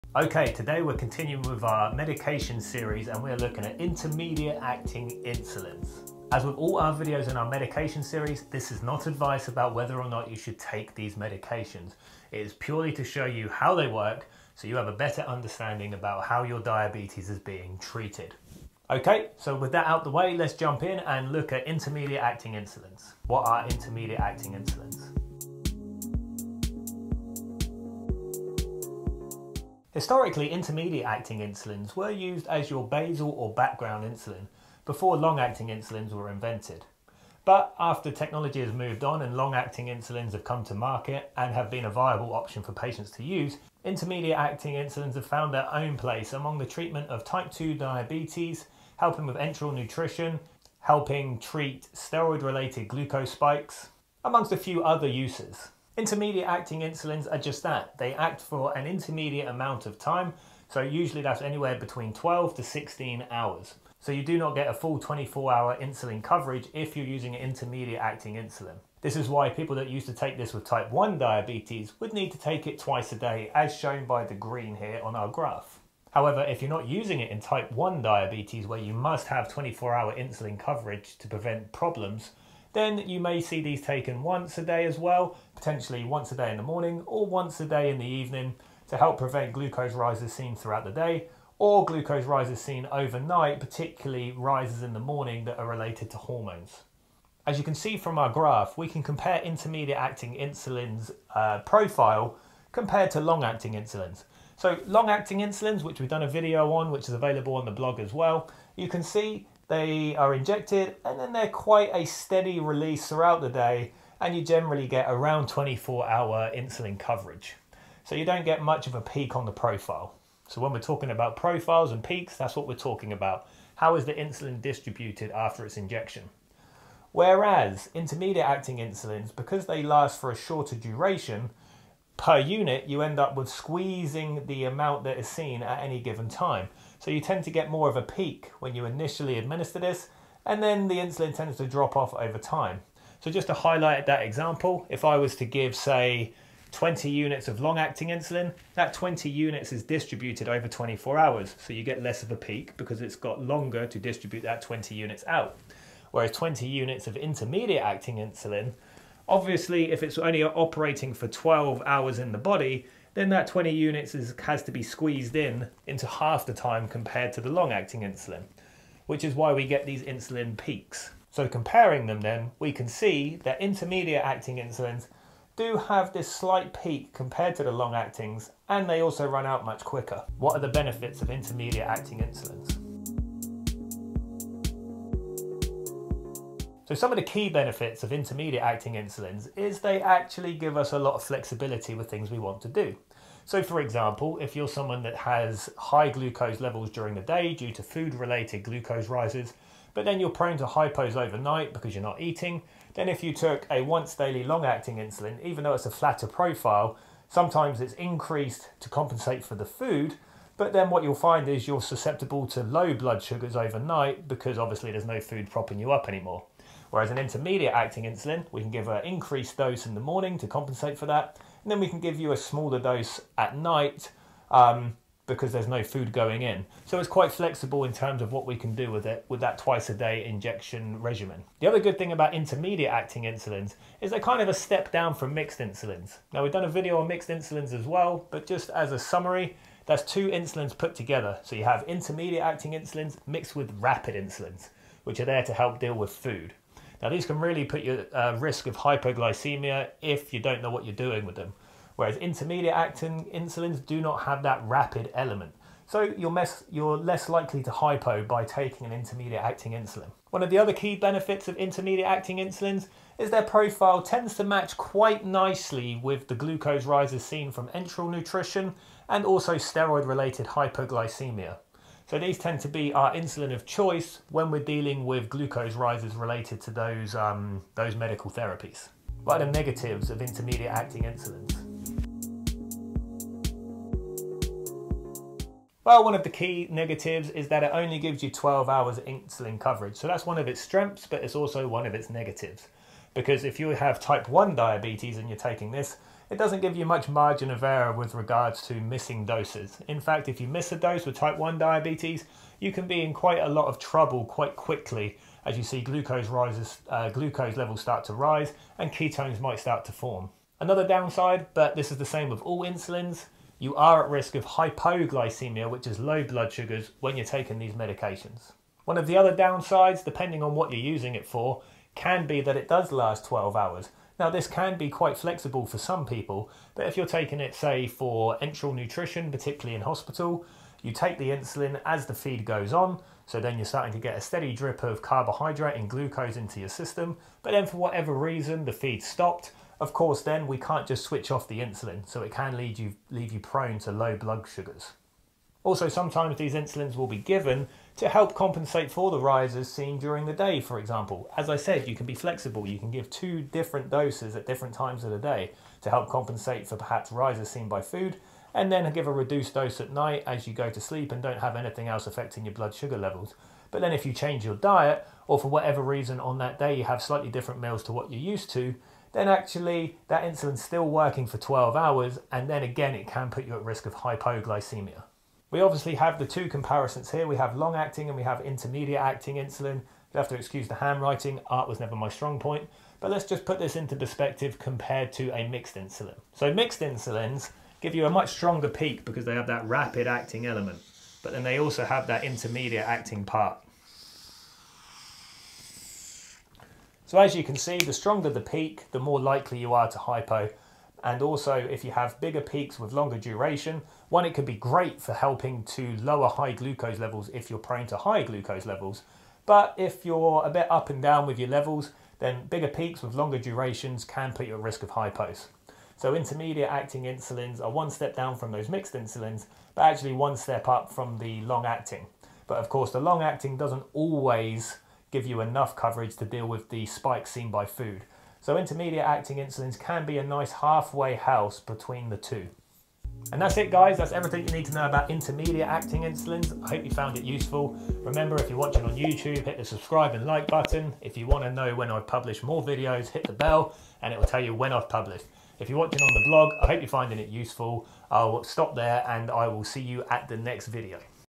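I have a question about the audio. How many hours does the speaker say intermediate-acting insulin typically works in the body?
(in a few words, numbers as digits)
12 to 16 hours.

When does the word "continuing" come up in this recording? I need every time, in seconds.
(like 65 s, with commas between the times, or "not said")
0 s.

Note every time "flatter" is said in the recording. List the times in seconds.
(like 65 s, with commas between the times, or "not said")
205 s.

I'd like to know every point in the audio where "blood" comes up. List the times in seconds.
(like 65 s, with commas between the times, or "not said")
212 s, 316 s, 344 s, 362 s.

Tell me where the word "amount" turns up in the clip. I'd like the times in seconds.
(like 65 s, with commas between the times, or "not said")
59 s, 134 s.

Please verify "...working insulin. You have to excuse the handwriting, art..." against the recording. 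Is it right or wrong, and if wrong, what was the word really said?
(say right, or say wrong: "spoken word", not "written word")
wrong: "acting", not "working".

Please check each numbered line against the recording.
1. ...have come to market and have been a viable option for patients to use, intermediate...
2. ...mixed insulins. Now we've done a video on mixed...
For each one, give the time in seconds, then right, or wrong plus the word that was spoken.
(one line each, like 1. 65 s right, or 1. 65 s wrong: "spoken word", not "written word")
1. 40 s right
2. 235 s right.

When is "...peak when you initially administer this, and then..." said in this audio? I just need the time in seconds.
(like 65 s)
138 s.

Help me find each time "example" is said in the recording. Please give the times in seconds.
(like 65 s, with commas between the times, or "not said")
144 s, 193 s, 350 s.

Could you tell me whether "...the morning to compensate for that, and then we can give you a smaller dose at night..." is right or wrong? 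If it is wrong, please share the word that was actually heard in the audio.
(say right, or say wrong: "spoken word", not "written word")
right.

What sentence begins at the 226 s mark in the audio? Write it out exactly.
So it's quite flexible in terms of what we can do with it with that twice a day injection regimen.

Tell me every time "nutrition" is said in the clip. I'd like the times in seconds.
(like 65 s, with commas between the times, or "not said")
49 s, 268 s, 328 s.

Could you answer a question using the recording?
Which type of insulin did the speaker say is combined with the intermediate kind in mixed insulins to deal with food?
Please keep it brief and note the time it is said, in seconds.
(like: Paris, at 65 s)
rapid insulins, at 243 s.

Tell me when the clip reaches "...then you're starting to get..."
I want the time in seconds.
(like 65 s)
333 s.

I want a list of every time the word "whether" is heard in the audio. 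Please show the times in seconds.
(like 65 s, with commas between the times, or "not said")
9 s.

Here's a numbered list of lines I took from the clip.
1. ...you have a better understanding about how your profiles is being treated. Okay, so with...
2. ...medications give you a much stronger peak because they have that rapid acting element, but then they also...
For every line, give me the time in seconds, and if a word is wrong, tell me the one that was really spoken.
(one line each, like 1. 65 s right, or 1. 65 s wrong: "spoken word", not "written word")
1. 14 s wrong: "diabetes", not "profiles"
2. 386 s wrong: "insulins", not "medications".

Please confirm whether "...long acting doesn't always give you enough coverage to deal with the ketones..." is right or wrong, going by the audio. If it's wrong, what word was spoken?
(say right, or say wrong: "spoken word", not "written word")
wrong: "spikes", not "ketones".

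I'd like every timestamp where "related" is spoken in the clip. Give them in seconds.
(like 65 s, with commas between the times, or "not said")
52 s, 95 s, 198 s, 270 s, 276 s.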